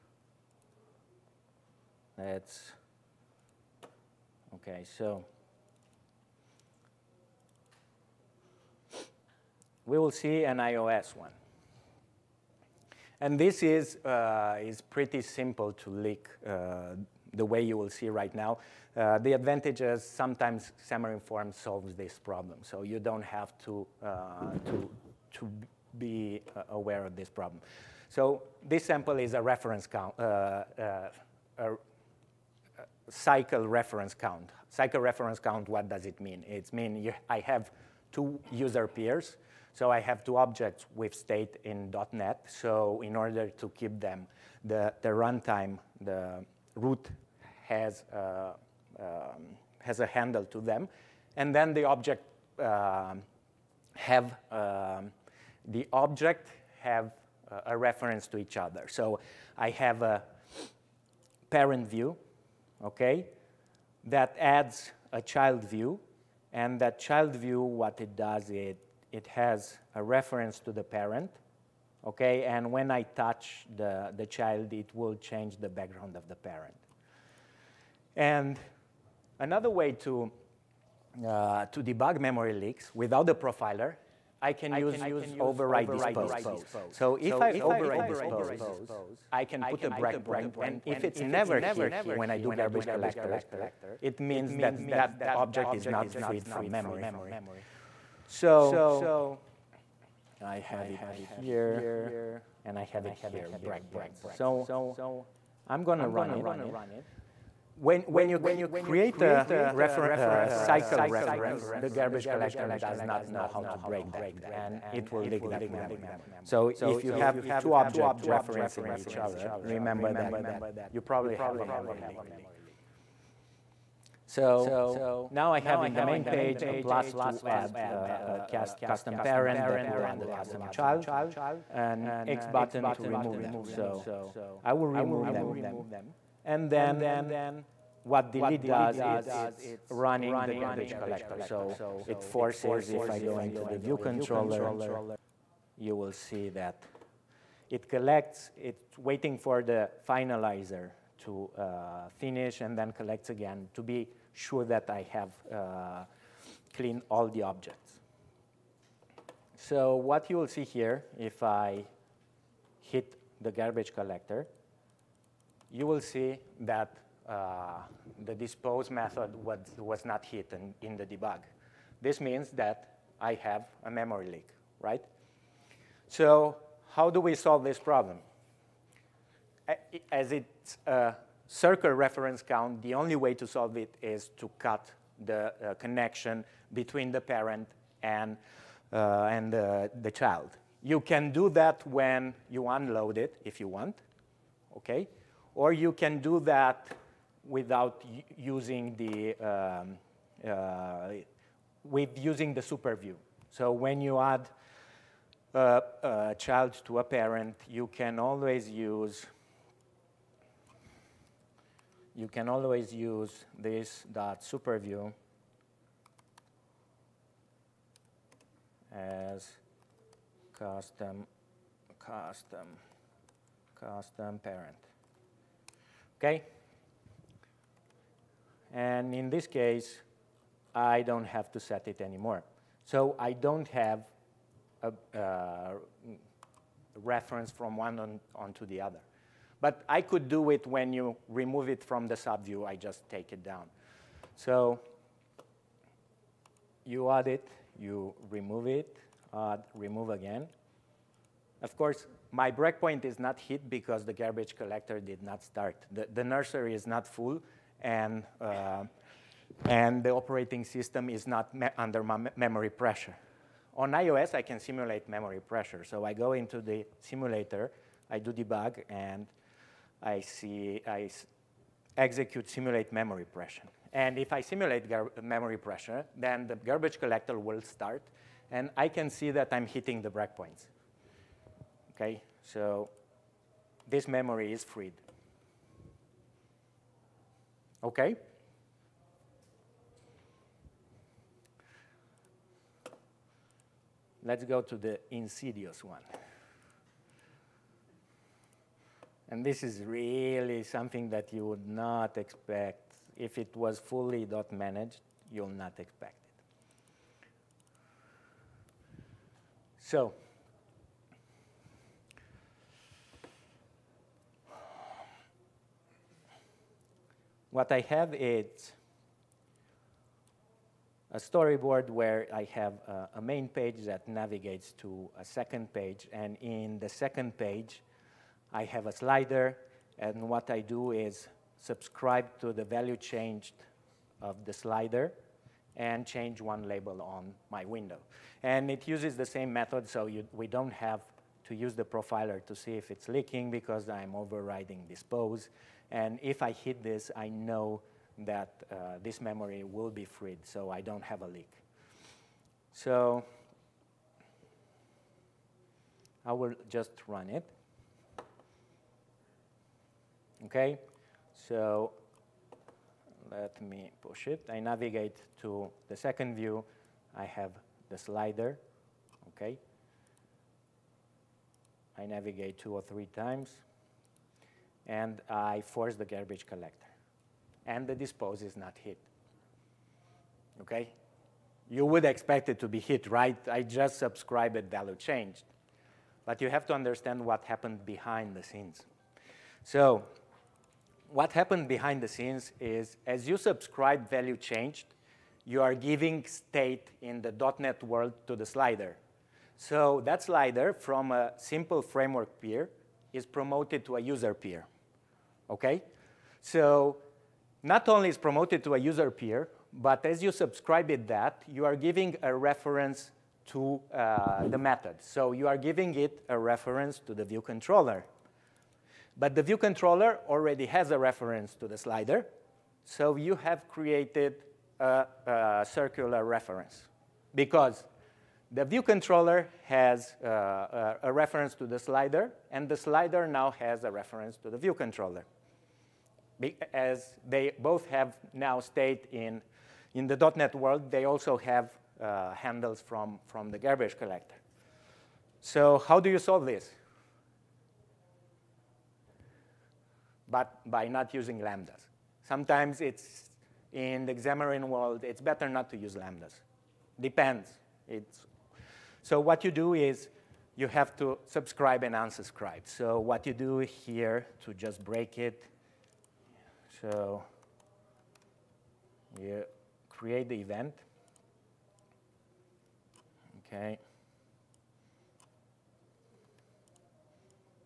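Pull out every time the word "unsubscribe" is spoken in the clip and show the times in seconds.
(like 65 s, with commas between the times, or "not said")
461 s.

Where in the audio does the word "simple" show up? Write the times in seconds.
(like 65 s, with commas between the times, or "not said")
15 s, 401 s.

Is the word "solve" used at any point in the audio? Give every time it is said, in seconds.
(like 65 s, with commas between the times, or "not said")
21 s, 177 s, 183 s, 446 s.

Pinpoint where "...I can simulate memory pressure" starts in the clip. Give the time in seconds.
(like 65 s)
264 s.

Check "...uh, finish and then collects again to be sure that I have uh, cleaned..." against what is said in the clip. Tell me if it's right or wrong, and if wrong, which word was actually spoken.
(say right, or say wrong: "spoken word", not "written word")
right.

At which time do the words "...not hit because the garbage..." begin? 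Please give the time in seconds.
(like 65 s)
253 s.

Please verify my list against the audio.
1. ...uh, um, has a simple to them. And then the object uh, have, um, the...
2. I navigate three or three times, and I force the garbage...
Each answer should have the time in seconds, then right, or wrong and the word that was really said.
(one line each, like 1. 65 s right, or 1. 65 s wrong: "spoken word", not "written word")
1. 48 s wrong: "handle", not "simple"
2. 371 s wrong: "two", not "three".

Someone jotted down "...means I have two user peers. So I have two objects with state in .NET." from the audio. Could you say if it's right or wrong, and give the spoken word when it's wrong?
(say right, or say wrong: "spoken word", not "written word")
right.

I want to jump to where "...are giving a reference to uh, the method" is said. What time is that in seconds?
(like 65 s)
411 s.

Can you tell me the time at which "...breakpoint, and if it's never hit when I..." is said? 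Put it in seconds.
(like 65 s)
89 s.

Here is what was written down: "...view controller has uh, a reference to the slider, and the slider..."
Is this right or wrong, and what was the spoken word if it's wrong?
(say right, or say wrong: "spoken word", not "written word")
right.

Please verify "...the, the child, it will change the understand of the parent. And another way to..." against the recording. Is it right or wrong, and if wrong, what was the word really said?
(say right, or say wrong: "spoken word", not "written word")
wrong: "background", not "understand".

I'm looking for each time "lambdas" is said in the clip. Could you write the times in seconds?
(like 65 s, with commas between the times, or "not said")
451 s, 455 s.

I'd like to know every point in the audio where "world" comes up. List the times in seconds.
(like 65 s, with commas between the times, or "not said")
397 s, 440 s, 454 s.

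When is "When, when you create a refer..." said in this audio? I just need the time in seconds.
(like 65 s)
107 s.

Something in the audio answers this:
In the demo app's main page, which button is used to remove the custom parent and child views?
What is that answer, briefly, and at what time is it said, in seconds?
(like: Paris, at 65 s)
X button, at 131 s.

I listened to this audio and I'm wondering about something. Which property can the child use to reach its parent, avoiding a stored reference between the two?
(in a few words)
superview.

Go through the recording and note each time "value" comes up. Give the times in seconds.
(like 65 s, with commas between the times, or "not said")
332 s, 384 s, 394 s.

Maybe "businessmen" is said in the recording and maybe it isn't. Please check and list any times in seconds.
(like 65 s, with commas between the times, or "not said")
not said.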